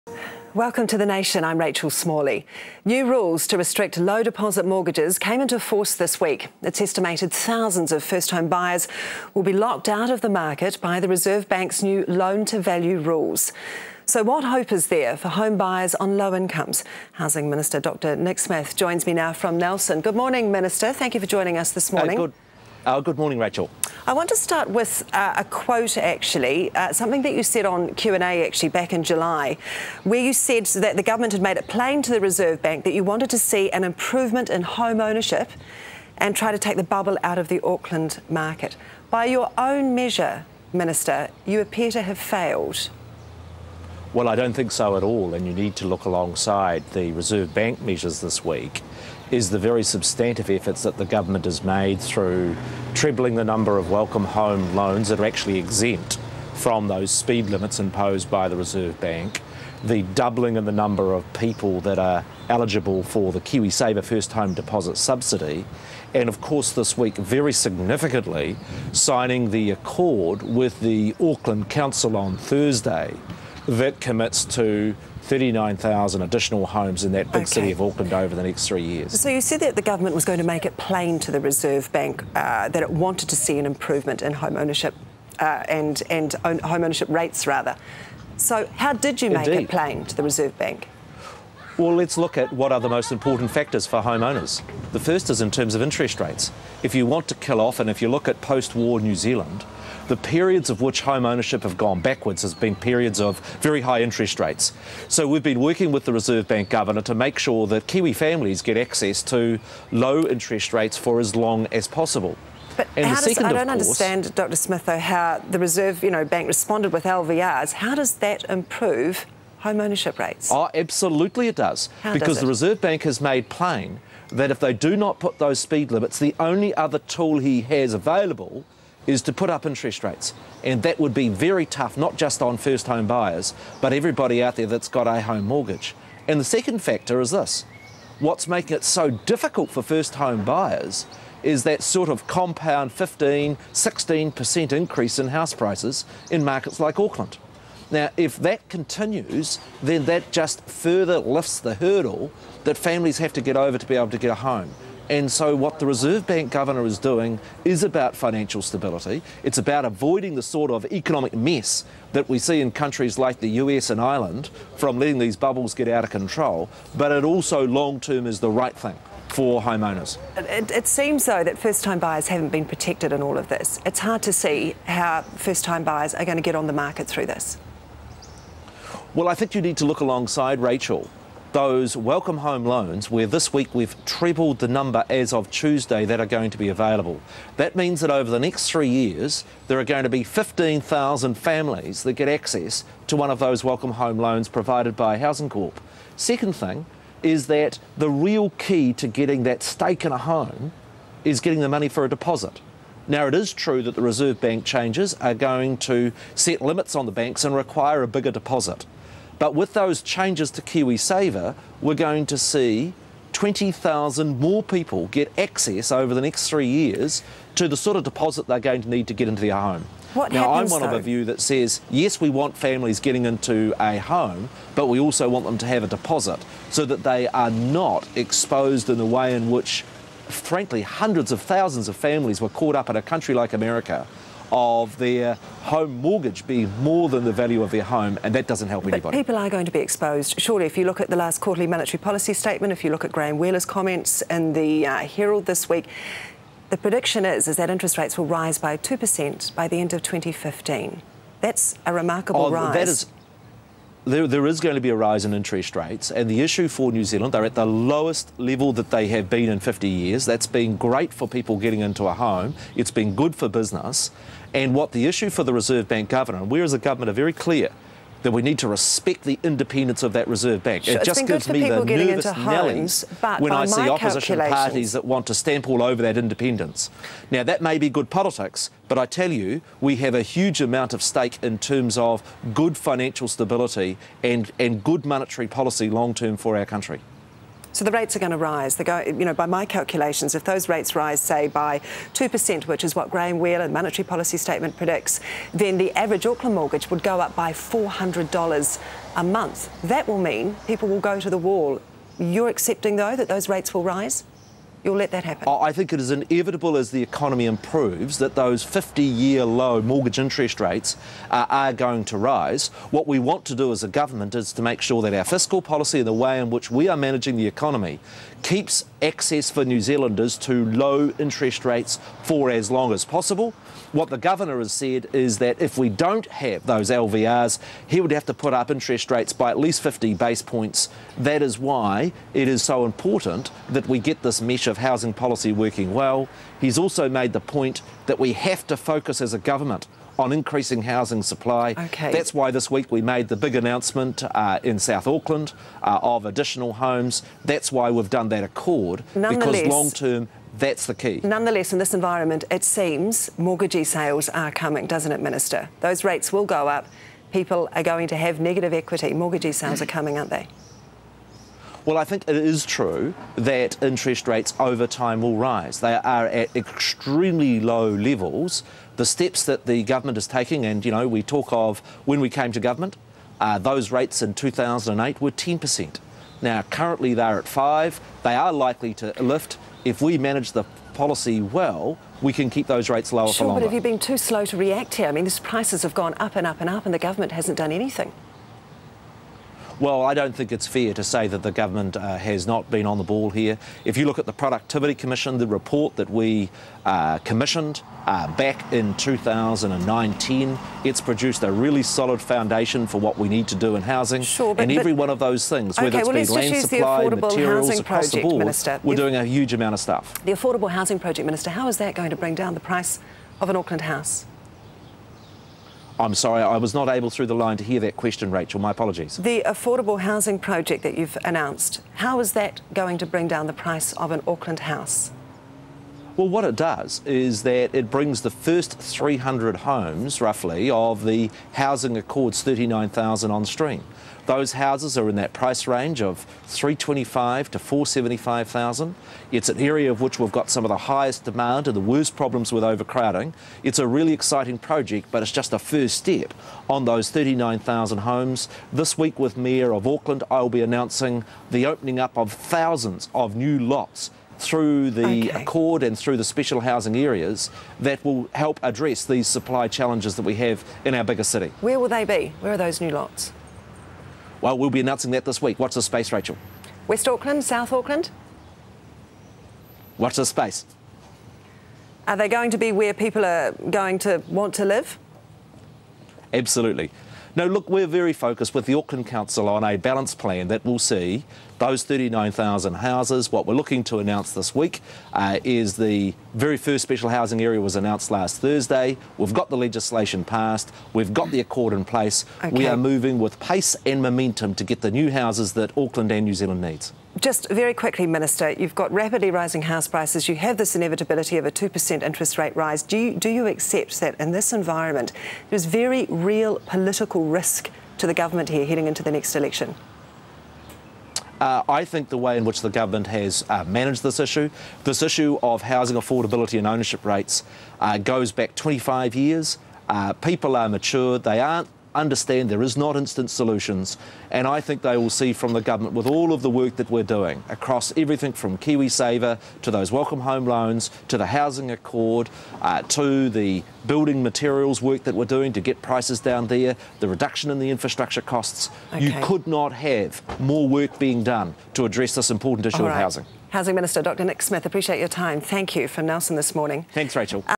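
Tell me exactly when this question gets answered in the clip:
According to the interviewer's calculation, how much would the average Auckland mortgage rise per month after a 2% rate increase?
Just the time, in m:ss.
4:57.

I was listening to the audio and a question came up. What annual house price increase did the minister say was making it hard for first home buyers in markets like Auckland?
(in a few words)
15, 16%.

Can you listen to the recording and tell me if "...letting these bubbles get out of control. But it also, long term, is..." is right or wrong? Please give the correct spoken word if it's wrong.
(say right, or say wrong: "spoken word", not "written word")
right.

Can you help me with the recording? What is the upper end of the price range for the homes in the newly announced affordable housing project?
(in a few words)
475,000.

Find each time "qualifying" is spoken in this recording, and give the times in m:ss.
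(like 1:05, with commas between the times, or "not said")
not said.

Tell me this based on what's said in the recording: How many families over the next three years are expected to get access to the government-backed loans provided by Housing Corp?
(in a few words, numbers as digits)
15,000.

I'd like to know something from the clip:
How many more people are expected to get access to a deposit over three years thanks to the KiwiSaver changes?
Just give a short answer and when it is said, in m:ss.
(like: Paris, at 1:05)
20,000, at 3:33.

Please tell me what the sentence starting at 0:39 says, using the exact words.
By your own measure, Minister, you appear to have failed.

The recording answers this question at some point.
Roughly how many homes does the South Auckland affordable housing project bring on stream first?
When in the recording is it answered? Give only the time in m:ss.
7:08.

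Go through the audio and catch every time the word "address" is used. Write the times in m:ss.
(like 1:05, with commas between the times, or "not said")
7:38, 9:01.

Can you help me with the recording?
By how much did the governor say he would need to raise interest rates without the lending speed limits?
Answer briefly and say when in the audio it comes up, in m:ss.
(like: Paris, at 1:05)
50 base points, at 5:29.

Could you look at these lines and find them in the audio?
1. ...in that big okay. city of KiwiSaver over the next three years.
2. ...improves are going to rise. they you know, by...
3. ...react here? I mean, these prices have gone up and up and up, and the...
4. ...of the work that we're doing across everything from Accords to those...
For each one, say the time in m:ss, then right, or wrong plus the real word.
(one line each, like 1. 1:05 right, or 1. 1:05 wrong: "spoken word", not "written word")
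1. 1:17 wrong: "Auckland", not "KiwiSaver"
2. 4:47 wrong: "rates", not "improves"
3. 6:24 right
4. 8:46 wrong: "KiwiSaver", not "Accords".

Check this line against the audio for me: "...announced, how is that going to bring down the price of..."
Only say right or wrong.
right.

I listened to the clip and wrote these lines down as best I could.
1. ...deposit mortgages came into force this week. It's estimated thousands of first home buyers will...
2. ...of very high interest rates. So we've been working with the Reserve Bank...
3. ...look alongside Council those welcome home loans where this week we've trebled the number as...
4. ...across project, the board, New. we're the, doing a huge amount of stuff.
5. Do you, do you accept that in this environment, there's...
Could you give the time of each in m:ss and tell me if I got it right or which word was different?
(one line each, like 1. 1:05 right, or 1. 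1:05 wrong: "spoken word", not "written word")
1. 0:04 right
2. 1:43 right
3. 2:59 wrong: "Rachel", not "Council"
4. 6:47 wrong: "Minister", not "New"
5. 8:22 right.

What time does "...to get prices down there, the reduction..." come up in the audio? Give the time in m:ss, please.
8:55.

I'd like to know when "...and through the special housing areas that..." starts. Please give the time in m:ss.
7:35.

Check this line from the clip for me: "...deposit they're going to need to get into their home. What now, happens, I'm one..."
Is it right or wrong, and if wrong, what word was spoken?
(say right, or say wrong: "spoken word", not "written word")
right.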